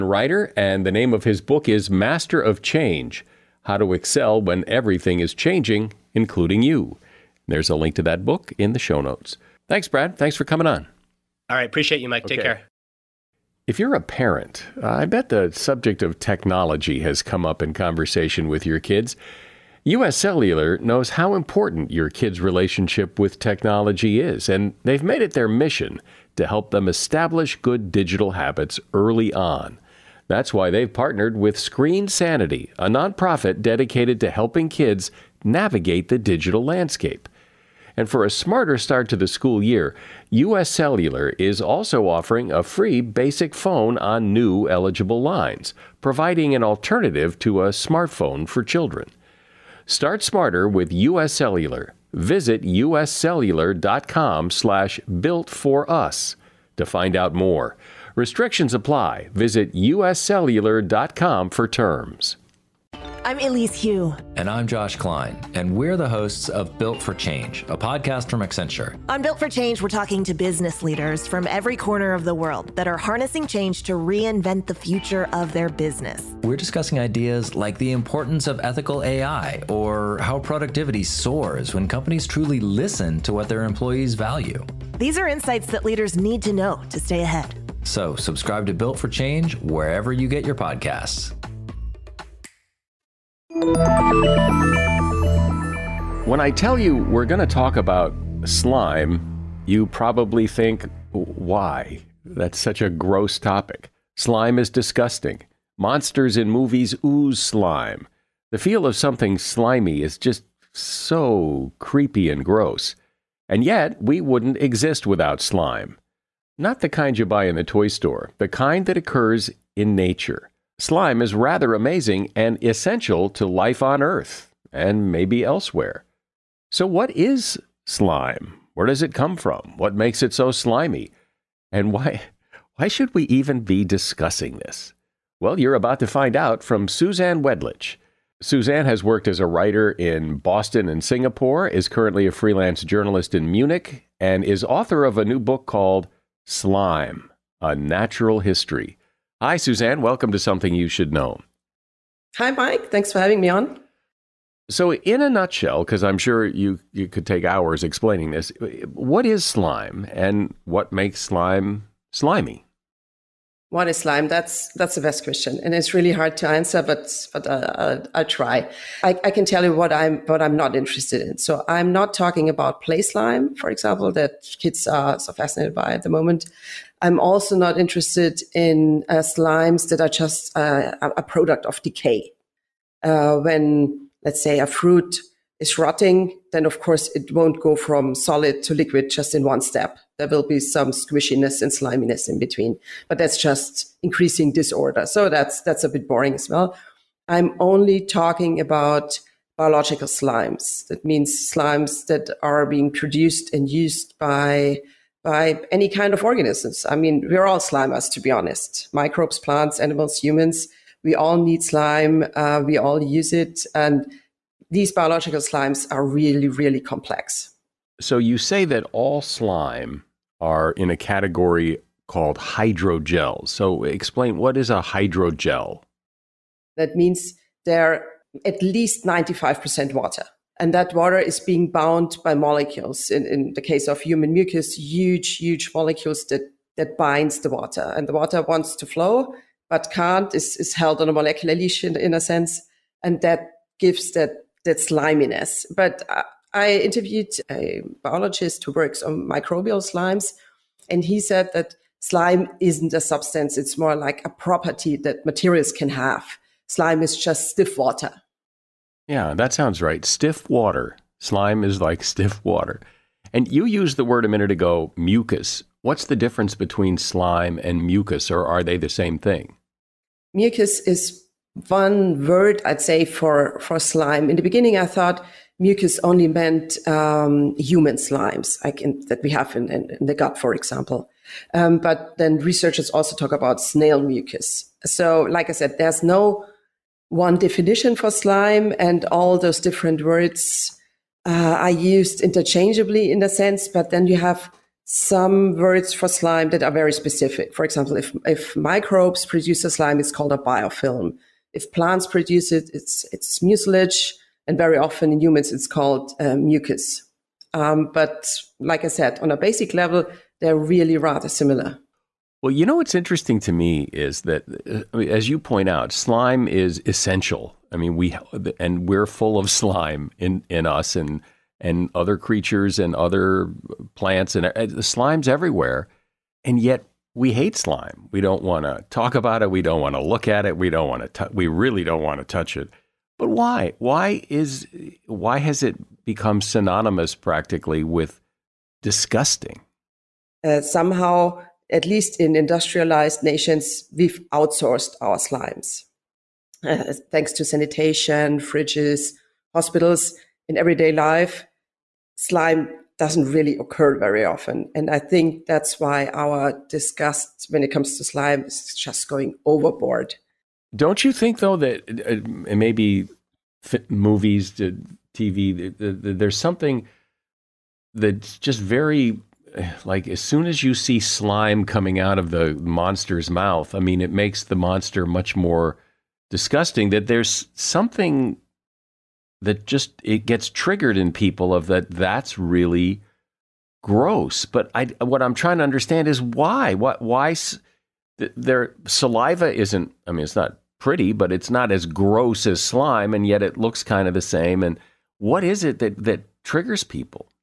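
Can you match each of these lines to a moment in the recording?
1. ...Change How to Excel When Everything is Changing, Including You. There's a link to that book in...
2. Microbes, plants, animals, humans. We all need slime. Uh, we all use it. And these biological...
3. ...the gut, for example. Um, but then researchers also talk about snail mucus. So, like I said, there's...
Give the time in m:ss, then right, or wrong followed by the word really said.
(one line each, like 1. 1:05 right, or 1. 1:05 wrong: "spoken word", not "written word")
1. 0:02 right
2. 3:28 right
3. 4:40 right.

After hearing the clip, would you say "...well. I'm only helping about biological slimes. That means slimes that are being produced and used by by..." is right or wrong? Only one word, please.
wrong.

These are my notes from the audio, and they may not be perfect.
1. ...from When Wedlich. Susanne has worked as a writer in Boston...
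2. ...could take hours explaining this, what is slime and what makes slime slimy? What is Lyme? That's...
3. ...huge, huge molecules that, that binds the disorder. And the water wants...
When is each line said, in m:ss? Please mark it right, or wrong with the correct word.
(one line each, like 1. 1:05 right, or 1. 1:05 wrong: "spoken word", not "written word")
1. 2:16 wrong: "Susanne", not "When"
2. 2:37 right
3. 3:54 wrong: "water", not "disorder".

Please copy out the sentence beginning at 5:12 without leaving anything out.
Well, you know what's interesting to me is that, uh, as you point out, slime is essential.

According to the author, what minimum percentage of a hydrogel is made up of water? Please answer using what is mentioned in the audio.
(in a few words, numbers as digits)
95%.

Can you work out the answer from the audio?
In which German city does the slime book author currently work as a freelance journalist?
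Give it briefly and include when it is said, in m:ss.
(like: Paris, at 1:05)
Munich, at 2:23.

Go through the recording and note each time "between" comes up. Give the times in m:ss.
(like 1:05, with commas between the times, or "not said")
3:12, 4:26.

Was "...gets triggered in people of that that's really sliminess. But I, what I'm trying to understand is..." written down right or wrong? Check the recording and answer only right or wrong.
wrong.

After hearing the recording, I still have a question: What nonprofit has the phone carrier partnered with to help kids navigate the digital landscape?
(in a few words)
Screen Sanity.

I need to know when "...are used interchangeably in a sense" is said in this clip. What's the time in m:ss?
4:51.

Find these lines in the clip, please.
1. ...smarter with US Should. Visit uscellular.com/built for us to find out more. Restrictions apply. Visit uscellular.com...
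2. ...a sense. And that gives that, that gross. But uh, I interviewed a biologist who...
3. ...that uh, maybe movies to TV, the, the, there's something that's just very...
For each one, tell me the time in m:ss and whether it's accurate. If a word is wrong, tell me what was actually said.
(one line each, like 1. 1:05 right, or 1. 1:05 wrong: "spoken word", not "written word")
1. 0:50 wrong: "Cellular", not "Should"
2. 4:02 wrong: "sliminess", not "gross"
3. 6:01 right.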